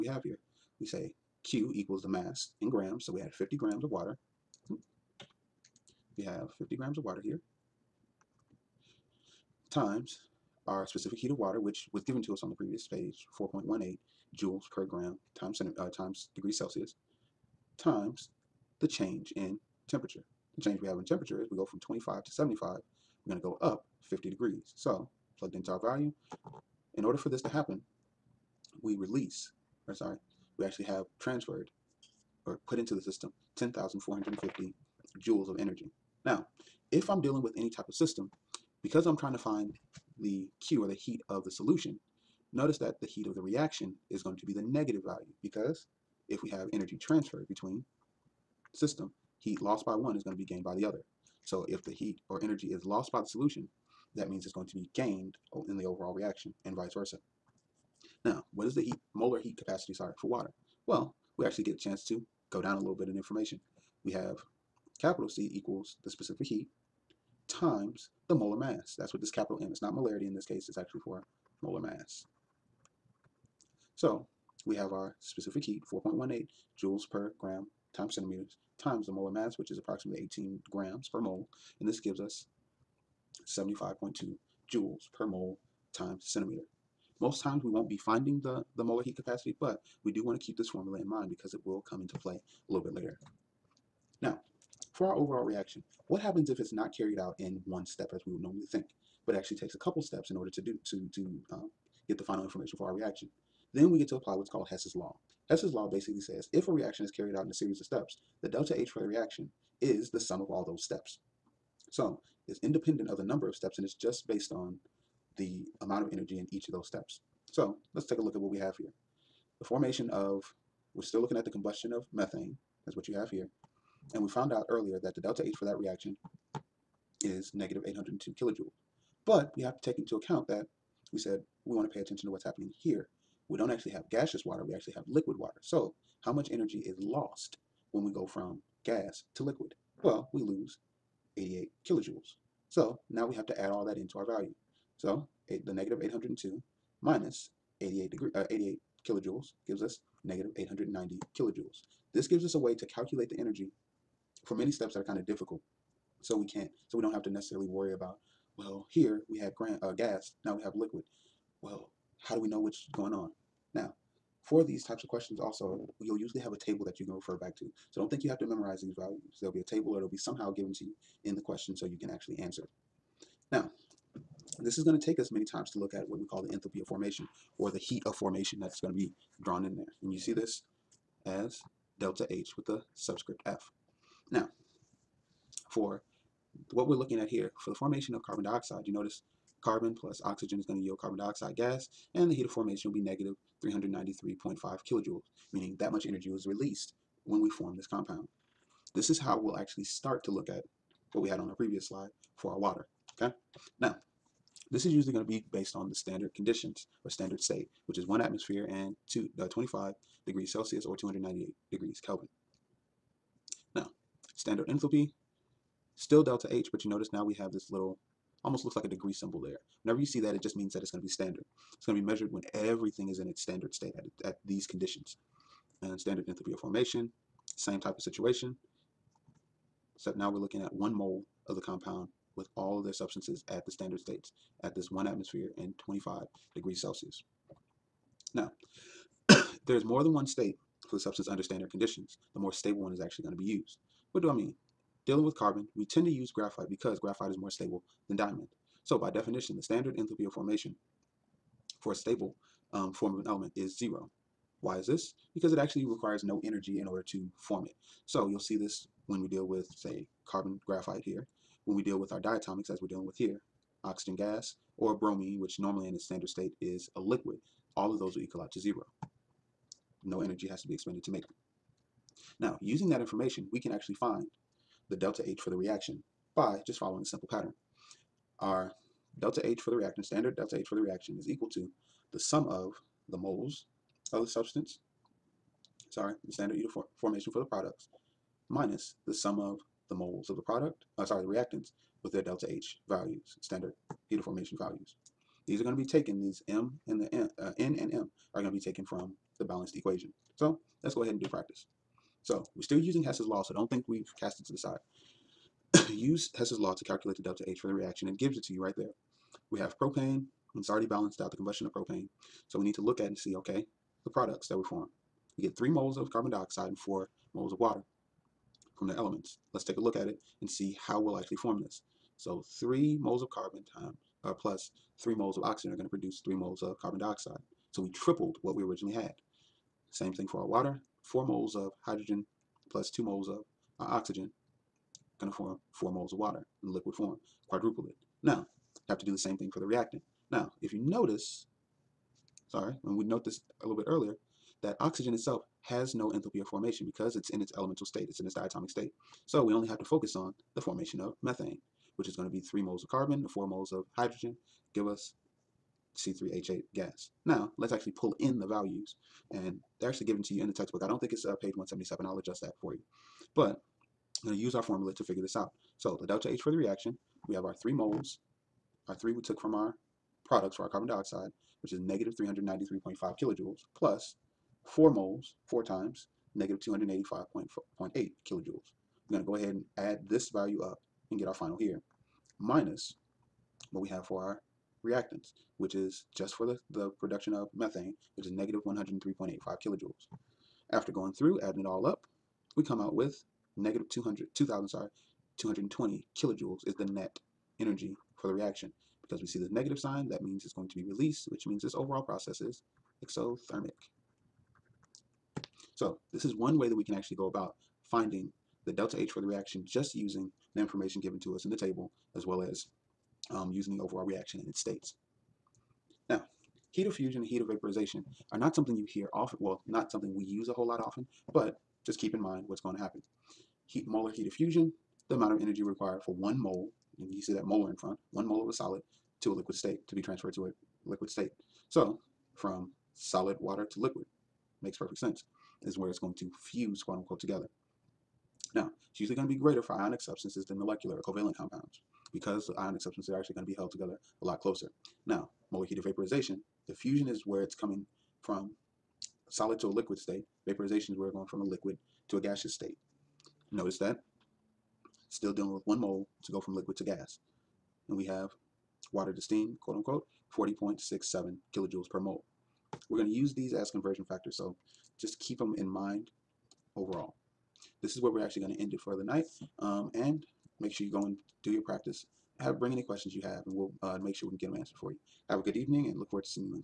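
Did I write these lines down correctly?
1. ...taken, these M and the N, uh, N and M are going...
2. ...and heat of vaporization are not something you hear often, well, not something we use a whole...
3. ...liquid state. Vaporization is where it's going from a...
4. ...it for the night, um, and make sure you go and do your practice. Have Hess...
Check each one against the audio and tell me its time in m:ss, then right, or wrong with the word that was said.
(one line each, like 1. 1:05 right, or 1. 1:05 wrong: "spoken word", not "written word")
1. 4:55 right
2. 6:57 right
3. 7:29 right
4. 7:48 wrong: "Bring", not "Hess".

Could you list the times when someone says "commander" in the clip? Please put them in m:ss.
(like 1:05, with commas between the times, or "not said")
not said.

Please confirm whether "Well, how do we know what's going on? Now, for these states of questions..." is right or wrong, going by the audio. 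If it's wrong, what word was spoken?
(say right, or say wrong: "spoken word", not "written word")
wrong: "types", not "states".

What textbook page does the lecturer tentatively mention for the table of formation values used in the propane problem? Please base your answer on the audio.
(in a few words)
177.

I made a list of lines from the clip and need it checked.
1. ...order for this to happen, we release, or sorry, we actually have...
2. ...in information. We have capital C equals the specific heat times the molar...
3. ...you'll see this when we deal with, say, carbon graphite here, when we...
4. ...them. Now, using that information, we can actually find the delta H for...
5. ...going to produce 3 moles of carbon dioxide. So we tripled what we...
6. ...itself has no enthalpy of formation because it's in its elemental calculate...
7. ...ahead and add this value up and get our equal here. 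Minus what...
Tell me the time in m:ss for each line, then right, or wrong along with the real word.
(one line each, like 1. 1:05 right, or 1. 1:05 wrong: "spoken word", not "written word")
1. 0:27 right
2. 1:03 right
3. 4:18 right
4. 4:31 right
5. 5:25 right
6. 5:45 wrong: "state", not "calculate"
7. 6:19 wrong: "final", not "equal".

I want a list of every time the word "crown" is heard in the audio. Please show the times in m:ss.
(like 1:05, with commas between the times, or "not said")
not said.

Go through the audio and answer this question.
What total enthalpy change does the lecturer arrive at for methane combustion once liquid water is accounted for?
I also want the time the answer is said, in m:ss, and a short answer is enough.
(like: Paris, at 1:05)
-890 kilojoules, at 2:30.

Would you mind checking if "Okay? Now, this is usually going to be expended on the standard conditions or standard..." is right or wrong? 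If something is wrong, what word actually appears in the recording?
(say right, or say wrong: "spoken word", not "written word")
wrong: "based", not "expended".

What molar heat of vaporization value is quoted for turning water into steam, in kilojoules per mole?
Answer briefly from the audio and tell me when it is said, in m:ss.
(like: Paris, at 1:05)
40.67, at 7:40.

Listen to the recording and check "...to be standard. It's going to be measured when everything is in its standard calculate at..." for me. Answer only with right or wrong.
wrong.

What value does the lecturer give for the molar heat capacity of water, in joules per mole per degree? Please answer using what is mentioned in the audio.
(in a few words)
75.2.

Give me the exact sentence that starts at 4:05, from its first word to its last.
Dealing with carbon, we tend to use graphite because graphite is more stable than diamond.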